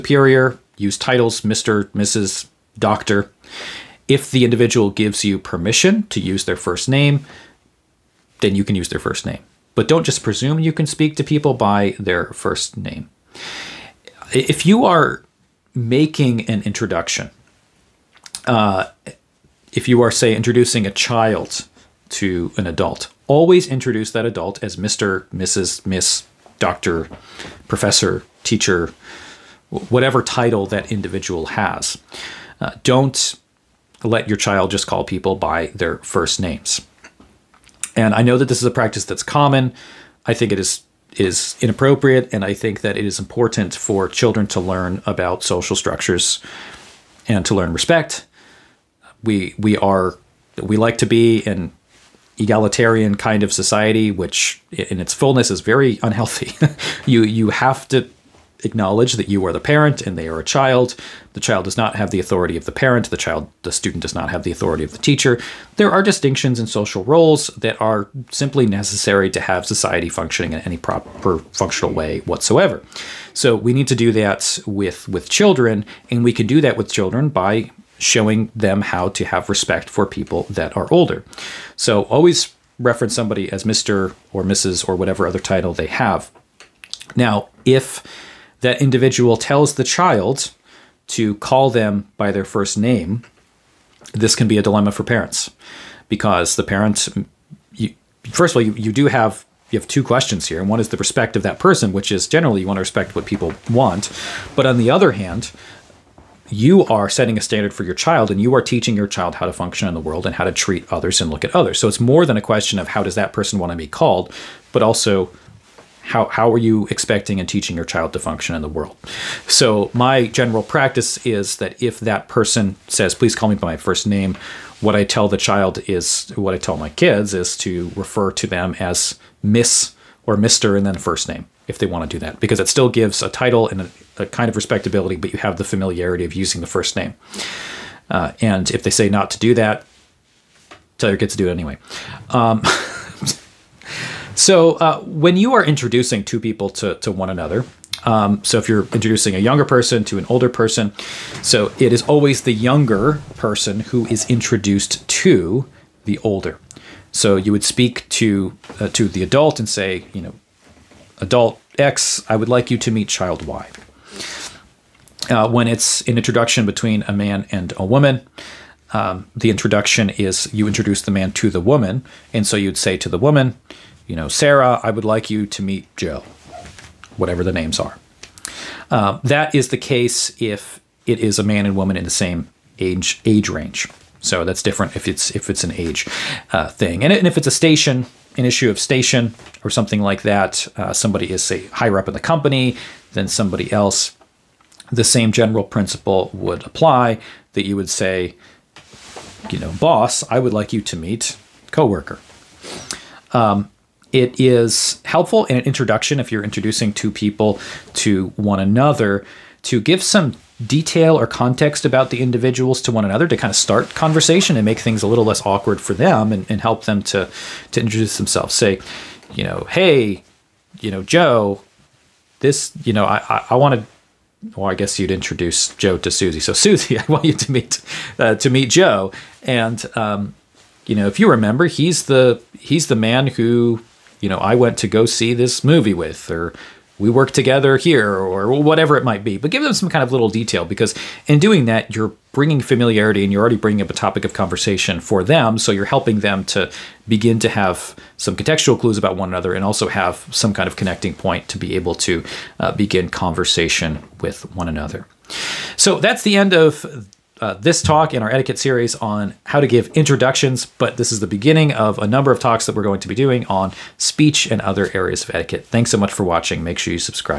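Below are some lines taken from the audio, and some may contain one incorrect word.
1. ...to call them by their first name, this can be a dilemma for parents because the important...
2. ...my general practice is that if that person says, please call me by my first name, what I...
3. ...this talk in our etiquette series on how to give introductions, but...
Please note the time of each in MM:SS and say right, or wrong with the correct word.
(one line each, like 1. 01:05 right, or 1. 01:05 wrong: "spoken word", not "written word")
1. 01:31 wrong: "parent", not "important"
2. 01:59 right
3. 04:17 right.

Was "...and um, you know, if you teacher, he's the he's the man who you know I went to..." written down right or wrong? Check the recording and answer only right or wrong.
wrong.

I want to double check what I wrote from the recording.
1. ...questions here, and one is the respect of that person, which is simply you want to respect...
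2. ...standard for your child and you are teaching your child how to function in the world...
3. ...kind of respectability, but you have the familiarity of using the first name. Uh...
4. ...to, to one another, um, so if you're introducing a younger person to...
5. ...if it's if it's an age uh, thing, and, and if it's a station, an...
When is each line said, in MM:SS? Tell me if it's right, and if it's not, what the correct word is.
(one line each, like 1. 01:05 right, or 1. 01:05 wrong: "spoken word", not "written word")
1. 01:40 wrong: "generally", not "simply"
2. 01:47 right
3. 02:14 right
4. 02:26 right
5. 03:04 right.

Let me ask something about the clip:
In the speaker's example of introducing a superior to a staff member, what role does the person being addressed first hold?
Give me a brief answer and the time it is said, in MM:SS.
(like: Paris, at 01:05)
boss, at 03:19.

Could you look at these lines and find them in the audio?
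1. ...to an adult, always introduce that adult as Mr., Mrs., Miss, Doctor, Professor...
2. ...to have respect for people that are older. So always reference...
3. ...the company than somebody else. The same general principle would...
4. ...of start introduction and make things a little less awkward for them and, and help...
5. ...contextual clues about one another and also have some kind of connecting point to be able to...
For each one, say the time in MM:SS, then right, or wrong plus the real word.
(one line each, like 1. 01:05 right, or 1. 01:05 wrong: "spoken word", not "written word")
1. 00:22 right
2. 01:19 right
3. 03:12 right
4. 03:33 wrong: "conversation", not "introduction"
5. 04:08 right.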